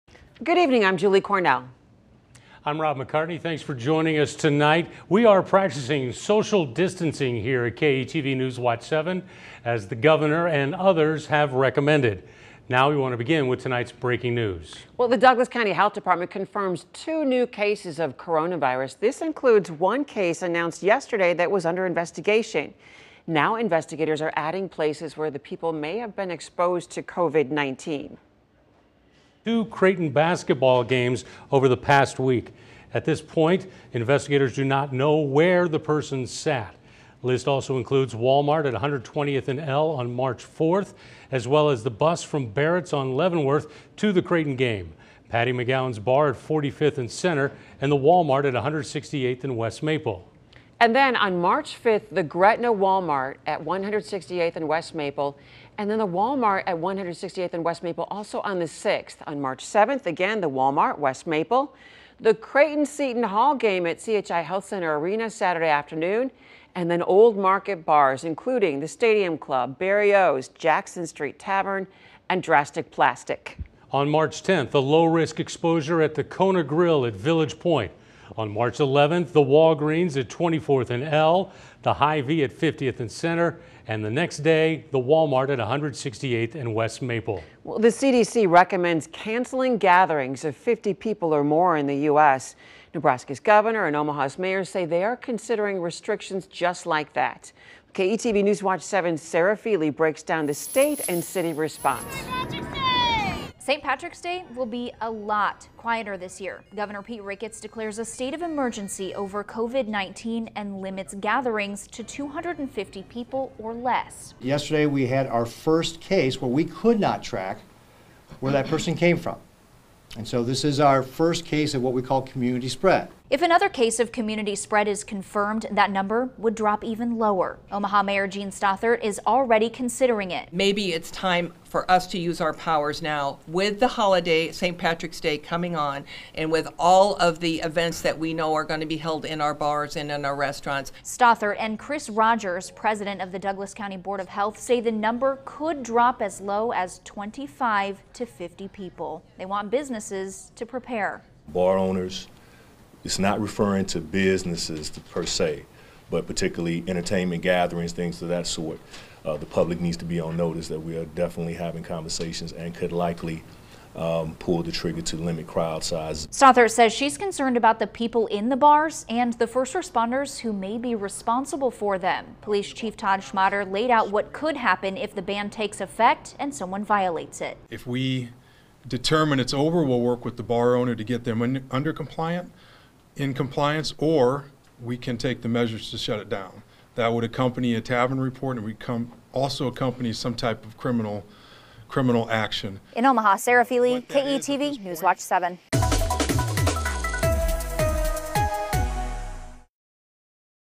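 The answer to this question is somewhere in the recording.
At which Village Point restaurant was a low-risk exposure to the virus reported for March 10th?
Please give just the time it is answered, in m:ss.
1:16.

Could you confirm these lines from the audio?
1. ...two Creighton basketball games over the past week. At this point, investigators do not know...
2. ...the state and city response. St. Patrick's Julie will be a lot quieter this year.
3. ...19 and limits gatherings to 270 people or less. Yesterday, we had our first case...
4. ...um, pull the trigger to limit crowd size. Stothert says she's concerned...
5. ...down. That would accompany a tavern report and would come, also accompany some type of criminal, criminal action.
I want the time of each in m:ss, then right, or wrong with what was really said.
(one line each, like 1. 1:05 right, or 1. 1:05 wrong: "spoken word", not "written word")
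1. 0:29 right
2. 1:40 wrong: "Day", not "Julie"
3. 1:49 wrong: "250", not "270"
4. 2:43 right
5. 3:06 right.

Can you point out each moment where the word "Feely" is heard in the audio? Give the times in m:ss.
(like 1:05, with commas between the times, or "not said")
1:39, 3:13.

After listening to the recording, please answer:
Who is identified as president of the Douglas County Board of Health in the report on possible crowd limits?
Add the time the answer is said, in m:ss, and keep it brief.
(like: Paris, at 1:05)
Chris Rogers, at 2:21.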